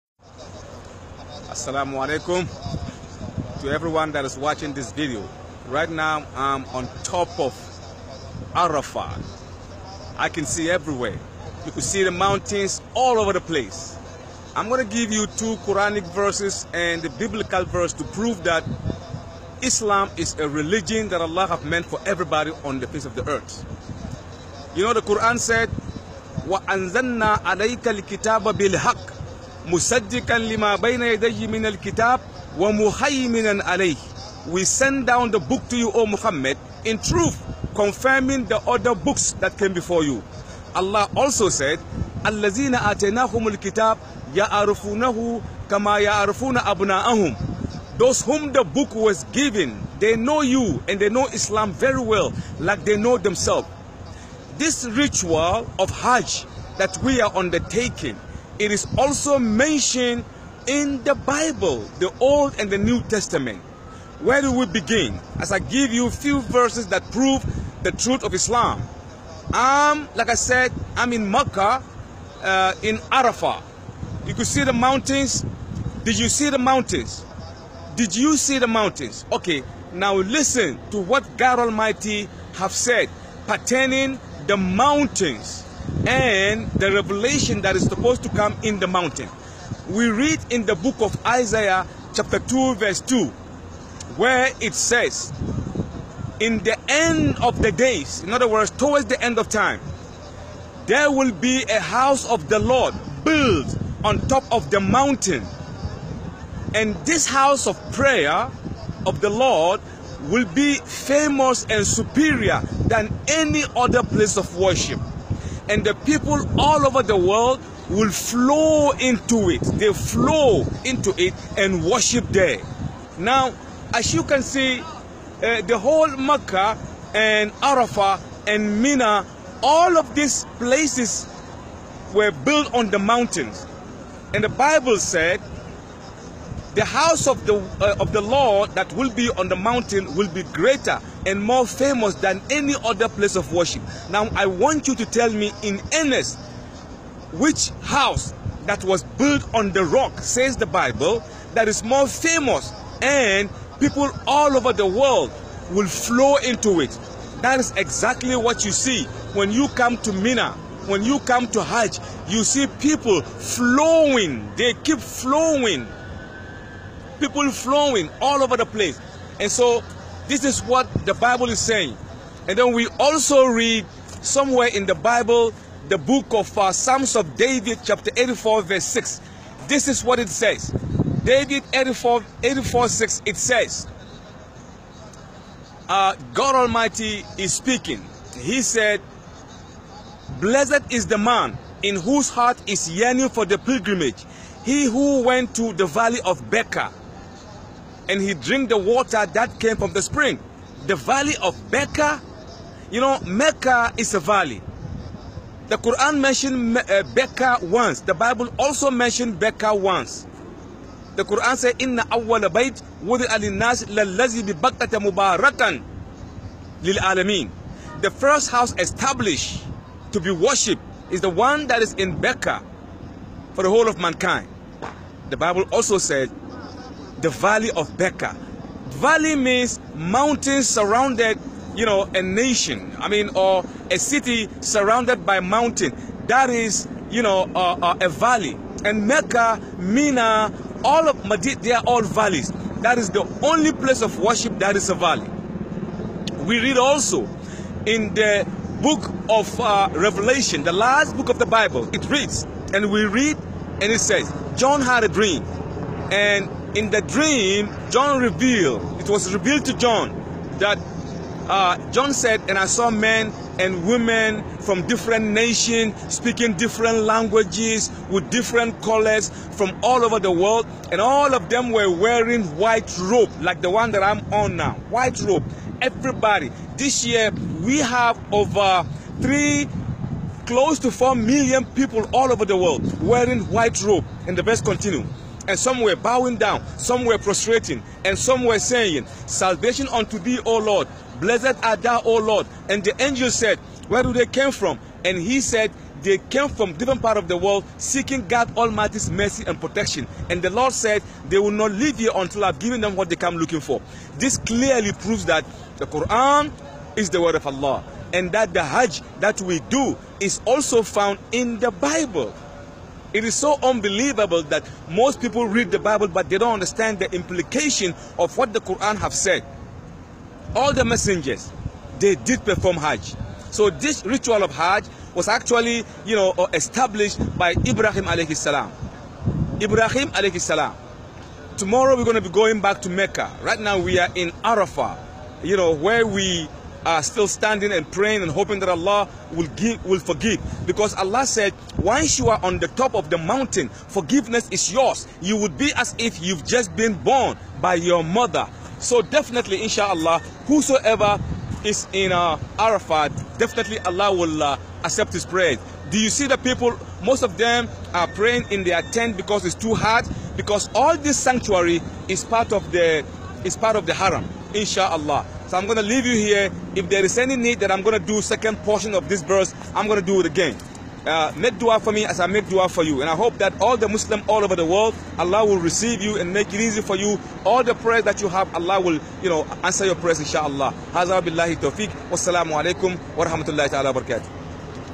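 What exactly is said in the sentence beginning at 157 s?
That is exactly what you see when you come to Mina, when you come to Hajj, you see people flowing.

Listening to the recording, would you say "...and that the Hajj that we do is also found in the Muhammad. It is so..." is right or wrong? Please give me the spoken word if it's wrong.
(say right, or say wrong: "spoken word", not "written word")
wrong: "Bible", not "Muhammad".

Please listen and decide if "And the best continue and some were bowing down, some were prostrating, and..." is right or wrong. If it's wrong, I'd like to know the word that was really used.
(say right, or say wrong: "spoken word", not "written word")
right.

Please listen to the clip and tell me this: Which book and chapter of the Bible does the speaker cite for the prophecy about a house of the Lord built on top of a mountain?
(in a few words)
Isaiah chapter 2.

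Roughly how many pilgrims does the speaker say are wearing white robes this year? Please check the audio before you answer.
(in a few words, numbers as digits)
close to 4 million.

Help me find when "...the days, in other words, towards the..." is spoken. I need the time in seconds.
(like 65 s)
97 s.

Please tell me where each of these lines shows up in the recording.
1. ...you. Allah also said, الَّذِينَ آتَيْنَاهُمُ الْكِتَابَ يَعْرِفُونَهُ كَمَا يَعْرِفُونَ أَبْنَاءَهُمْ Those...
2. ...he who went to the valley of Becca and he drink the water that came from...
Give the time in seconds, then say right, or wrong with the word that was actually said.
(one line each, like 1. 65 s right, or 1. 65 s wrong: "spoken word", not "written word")
1. 40 s right
2. 194 s right.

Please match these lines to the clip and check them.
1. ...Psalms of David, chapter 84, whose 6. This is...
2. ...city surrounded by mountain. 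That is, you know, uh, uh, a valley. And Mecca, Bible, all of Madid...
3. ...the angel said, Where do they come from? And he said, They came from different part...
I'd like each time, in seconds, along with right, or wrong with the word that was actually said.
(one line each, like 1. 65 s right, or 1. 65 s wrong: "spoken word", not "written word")
1. 176 s wrong: "verse", not "whose"
2. 233 s wrong: "Mina", not "Bible"
3. 292 s right.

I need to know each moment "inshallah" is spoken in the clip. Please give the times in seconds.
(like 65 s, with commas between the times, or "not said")
349 s, 364 s, 380 s.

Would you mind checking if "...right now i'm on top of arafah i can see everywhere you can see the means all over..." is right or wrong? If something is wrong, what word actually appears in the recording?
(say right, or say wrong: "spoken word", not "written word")
wrong: "mountains", not "means".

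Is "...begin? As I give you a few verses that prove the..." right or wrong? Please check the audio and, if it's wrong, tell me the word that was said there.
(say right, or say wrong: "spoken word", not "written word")
right.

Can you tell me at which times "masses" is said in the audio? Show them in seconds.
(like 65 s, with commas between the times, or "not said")
not said.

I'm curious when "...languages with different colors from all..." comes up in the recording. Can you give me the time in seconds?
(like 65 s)
266 s.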